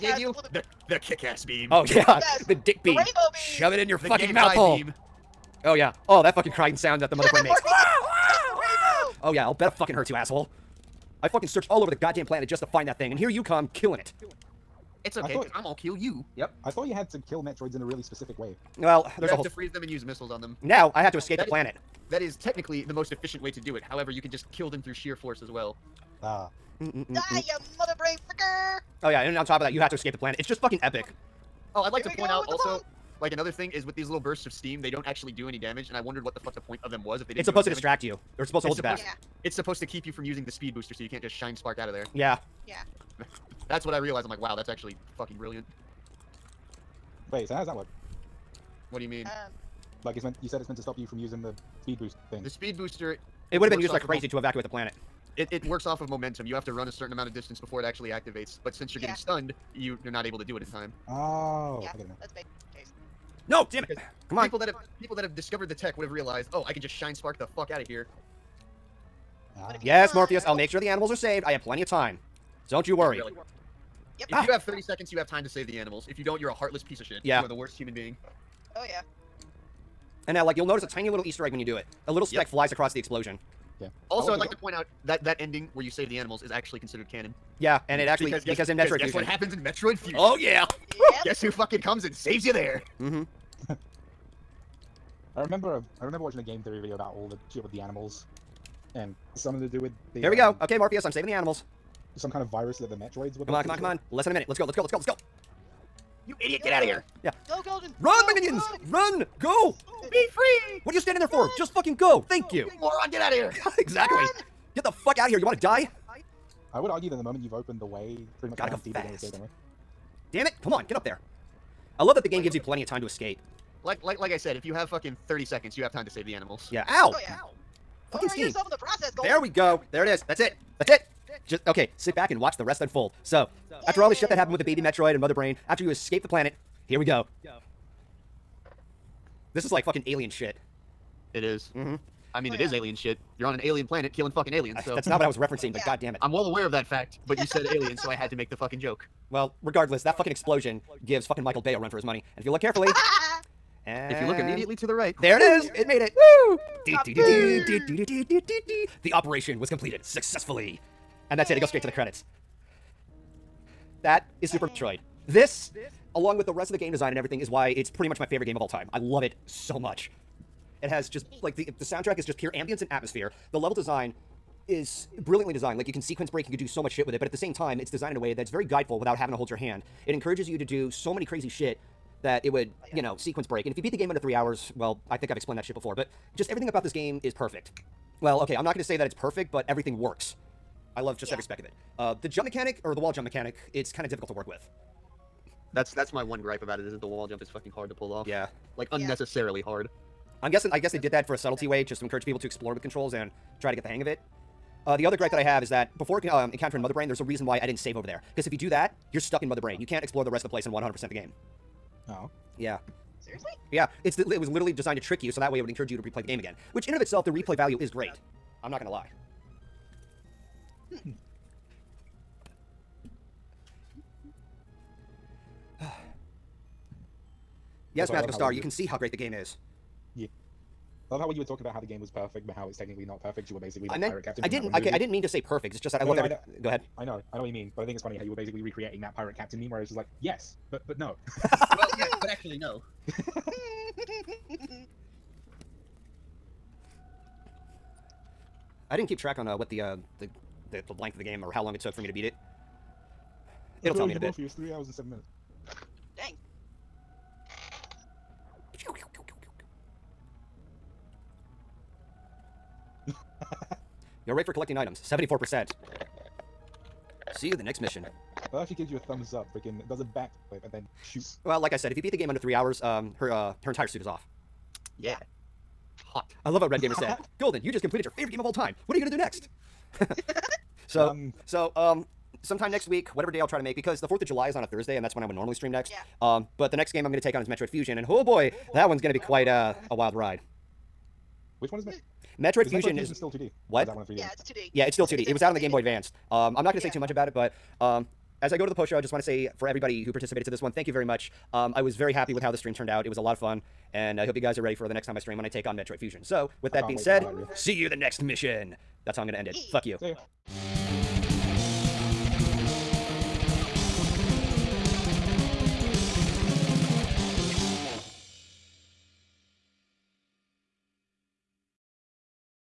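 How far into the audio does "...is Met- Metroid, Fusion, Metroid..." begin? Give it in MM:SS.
04:51.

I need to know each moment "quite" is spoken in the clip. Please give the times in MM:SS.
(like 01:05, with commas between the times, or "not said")
04:49.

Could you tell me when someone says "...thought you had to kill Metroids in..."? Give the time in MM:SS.
00:16.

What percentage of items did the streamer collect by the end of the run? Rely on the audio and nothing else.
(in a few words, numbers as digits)
74%.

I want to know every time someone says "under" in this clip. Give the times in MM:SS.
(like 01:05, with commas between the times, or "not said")
03:04, 04:32.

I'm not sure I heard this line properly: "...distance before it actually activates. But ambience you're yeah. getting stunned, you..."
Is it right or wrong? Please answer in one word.
wrong.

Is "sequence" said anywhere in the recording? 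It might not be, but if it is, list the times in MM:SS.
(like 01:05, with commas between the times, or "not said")
02:56, 03:03.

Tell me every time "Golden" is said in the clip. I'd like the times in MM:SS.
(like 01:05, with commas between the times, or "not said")
01:47, 02:09, 04:37.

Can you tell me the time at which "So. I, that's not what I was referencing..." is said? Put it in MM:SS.
02:24.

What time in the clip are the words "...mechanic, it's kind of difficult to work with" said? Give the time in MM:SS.
03:13.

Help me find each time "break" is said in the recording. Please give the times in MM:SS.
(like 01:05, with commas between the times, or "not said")
02:56, 03:03.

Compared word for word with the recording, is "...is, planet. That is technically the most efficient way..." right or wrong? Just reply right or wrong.
right.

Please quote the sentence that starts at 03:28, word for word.
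Because if you do that, you're stuck in Mother Brain.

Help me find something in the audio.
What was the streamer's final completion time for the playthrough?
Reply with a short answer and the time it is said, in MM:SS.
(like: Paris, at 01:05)
3 hours and 7 minutes, at 04:14.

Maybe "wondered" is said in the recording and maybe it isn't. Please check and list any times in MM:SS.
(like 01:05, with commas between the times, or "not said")
00:35.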